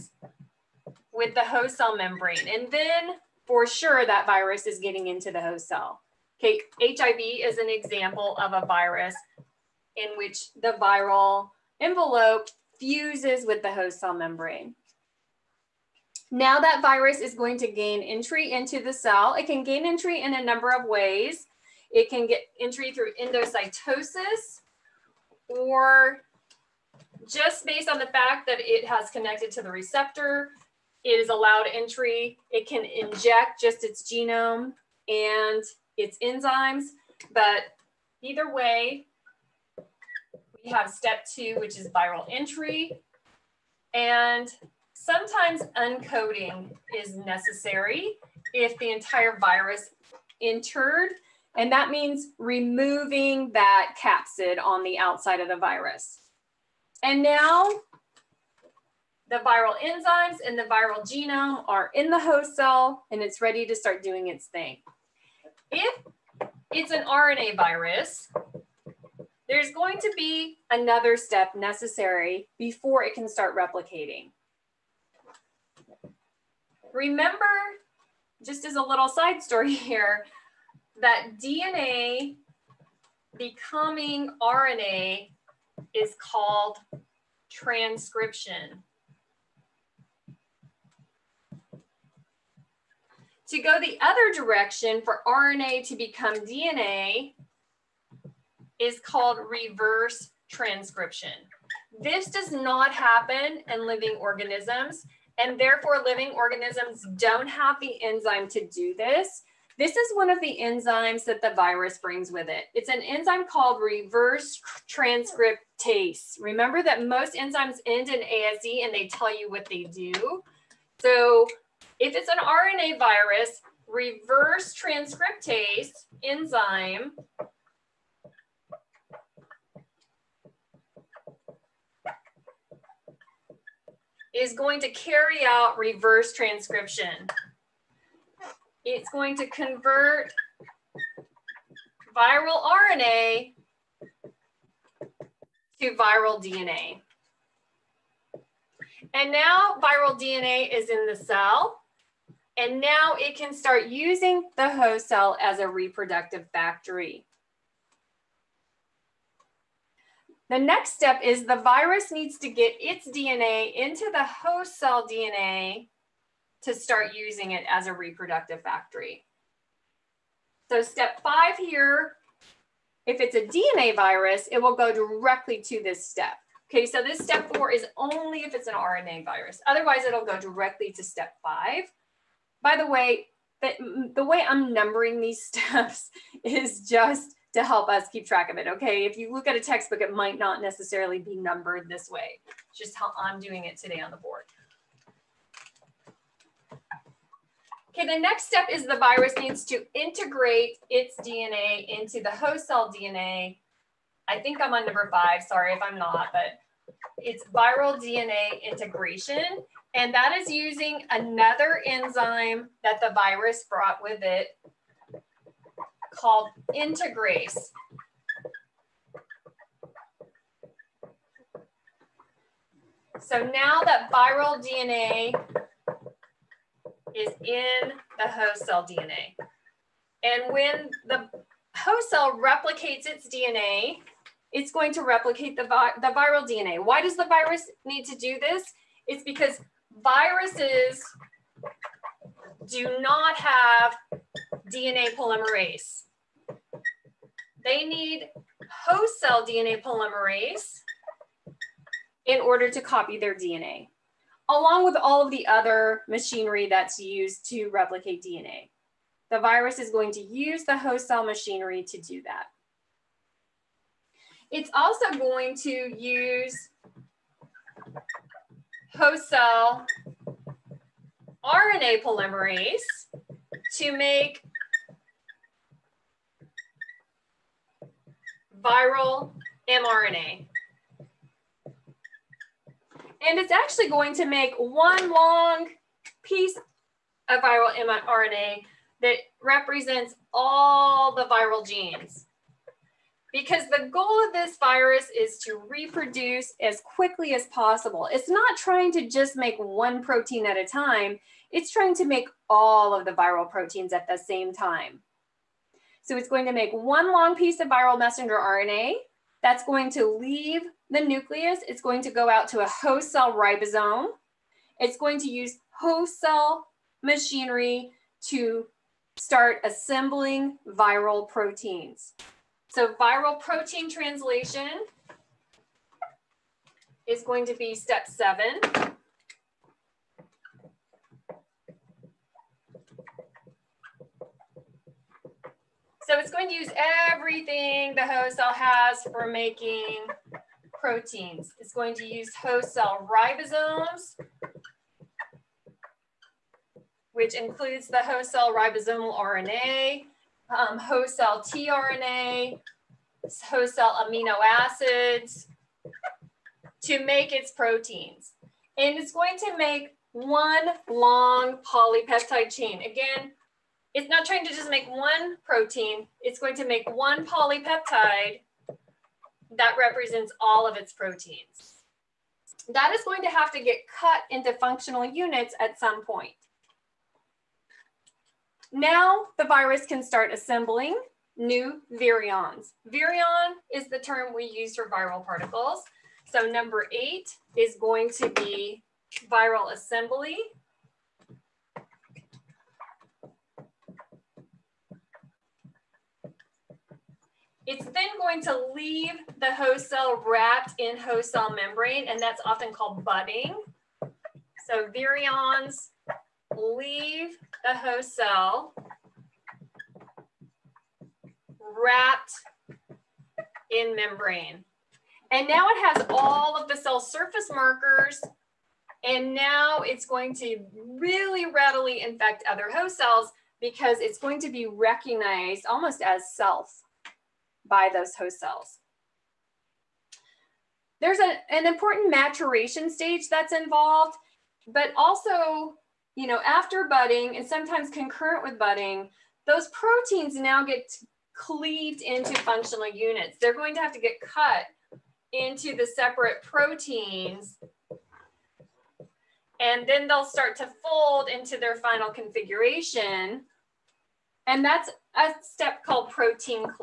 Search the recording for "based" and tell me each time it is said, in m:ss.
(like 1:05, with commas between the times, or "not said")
0:27.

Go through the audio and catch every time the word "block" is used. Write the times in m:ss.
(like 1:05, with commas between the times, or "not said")
not said.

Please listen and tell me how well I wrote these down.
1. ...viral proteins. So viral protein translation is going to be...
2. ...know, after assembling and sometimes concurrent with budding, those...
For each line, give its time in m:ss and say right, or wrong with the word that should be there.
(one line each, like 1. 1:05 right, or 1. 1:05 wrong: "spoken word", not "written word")
1. 5:20 right
2. 7:16 wrong: "budding", not "assembling".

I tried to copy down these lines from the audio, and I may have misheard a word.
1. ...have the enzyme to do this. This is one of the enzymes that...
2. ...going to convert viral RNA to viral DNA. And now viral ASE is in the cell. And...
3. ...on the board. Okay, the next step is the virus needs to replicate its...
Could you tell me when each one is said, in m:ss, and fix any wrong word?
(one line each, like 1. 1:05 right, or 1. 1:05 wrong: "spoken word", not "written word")
1. 1:47 right
2. 2:19 wrong: "DNA", not "ASE"
3. 3:14 wrong: "integrate", not "replicate".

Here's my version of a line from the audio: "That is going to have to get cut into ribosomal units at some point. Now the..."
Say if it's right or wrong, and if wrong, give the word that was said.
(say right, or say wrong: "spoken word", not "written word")
wrong: "functional", not "ribosomal".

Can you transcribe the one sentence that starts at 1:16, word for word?
Remember, just as a little side story here, that DNA becoming RNA is called transcription.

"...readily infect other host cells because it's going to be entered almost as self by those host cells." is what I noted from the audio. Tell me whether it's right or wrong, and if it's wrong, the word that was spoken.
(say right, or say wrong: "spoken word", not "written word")
wrong: "recognized", not "entered".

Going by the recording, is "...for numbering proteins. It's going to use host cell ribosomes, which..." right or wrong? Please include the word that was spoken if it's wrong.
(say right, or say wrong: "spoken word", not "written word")
wrong: "making", not "numbering".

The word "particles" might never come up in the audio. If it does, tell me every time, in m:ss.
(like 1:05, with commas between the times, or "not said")
6:25.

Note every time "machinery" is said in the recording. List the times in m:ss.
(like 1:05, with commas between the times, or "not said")
4:16, 4:21, 5:17.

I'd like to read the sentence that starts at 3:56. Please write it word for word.
Why does the virus need to do this?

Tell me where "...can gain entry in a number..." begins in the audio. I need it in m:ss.
0:19.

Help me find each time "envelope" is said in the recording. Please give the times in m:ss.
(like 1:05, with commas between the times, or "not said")
0:11.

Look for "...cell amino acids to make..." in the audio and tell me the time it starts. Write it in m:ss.
5:53.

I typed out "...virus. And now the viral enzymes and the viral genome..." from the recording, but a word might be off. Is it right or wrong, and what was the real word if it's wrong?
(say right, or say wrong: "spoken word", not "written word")
right.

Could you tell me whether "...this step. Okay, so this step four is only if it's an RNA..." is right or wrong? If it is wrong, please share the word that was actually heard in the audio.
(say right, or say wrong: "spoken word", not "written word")
right.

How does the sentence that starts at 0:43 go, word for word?
And sometimes uncoating is necessary if the entire virus entered.